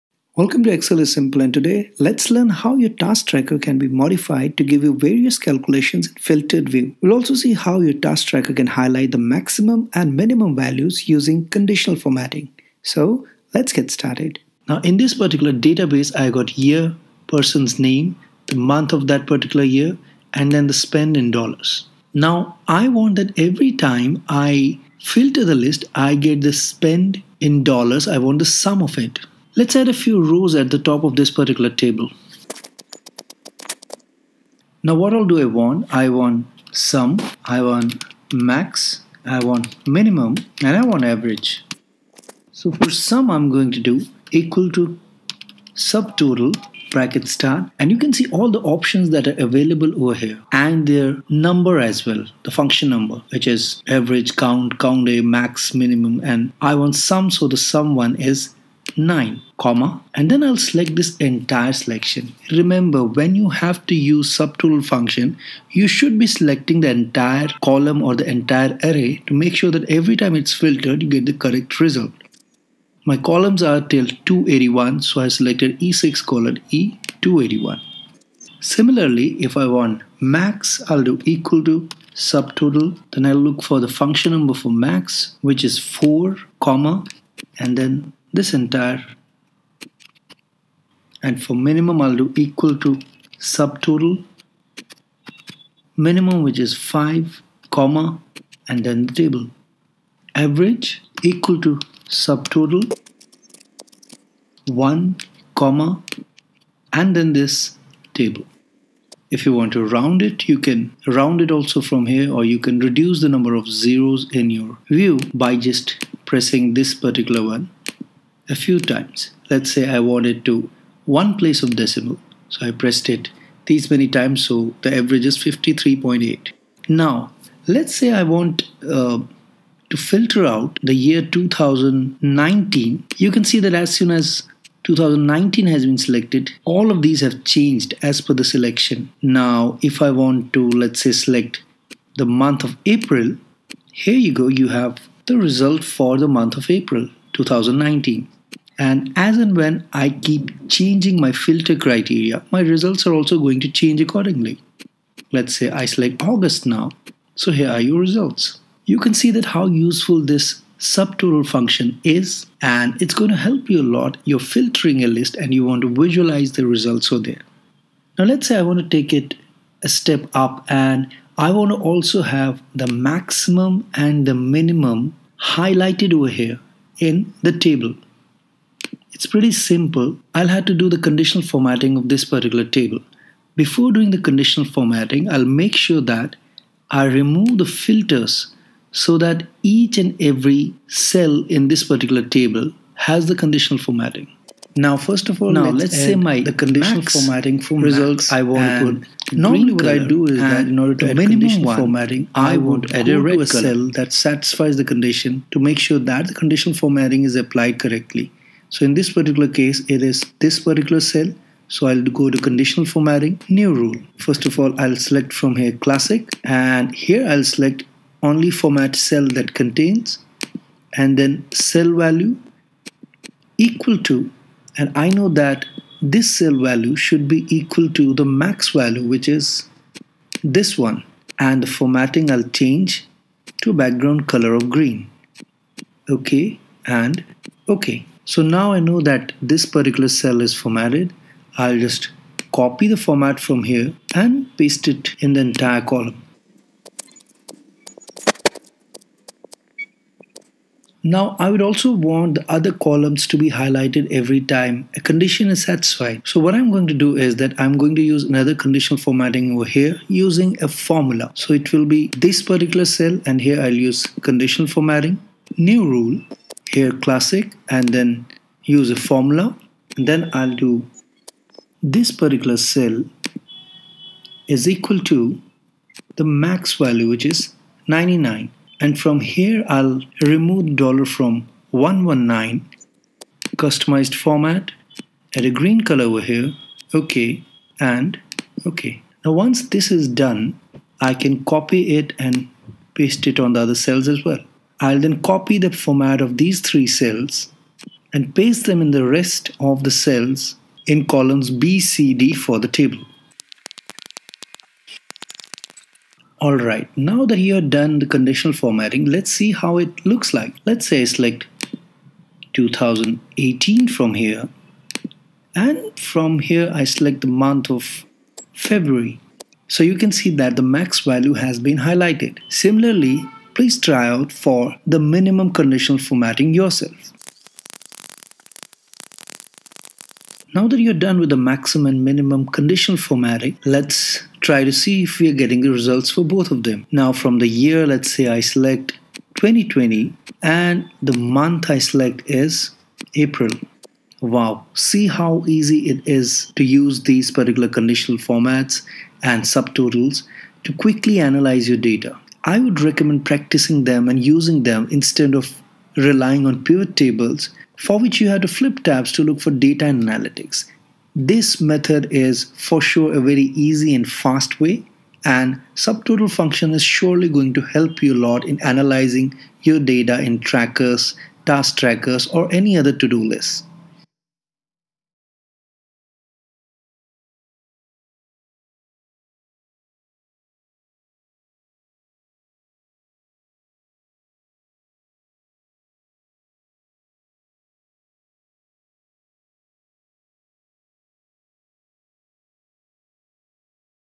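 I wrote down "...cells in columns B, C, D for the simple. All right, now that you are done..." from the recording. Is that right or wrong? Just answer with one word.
wrong.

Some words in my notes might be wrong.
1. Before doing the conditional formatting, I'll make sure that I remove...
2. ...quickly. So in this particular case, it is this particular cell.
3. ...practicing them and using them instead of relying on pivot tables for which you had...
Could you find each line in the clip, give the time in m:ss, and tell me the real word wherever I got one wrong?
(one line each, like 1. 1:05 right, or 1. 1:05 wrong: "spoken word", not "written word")
1. 3:03 right
2. 3:27 wrong: "correctly", not "quickly"
3. 5:53 right.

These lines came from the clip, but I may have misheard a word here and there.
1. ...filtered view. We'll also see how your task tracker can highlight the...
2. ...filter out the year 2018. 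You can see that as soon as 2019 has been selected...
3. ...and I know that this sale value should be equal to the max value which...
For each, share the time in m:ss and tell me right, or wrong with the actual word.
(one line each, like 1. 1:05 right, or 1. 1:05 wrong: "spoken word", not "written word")
1. 0:06 right
2. 2:09 wrong: "2019", not "2018"
3. 3:44 right.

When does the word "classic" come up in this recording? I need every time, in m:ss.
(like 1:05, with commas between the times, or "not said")
3:35, 4:26.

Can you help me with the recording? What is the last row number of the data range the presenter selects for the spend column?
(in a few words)
281.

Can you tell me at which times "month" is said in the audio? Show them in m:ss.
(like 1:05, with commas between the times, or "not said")
0:18, 2:22, 2:26, 5:17, 5:41.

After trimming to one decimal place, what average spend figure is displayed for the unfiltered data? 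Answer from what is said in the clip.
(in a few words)
53.8.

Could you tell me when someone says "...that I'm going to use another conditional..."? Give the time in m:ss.
4:17.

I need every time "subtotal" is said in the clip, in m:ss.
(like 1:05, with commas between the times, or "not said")
0:45, 1:04, 1:22, 1:33, 1:42, 2:40, 5:49, 6:05.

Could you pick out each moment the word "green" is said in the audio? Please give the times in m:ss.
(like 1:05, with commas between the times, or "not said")
3:54, 4:45.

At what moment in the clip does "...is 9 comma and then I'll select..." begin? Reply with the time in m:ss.
0:58.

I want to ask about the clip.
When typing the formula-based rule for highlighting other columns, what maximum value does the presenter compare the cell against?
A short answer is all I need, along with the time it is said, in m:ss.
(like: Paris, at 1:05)
99, at 4:36.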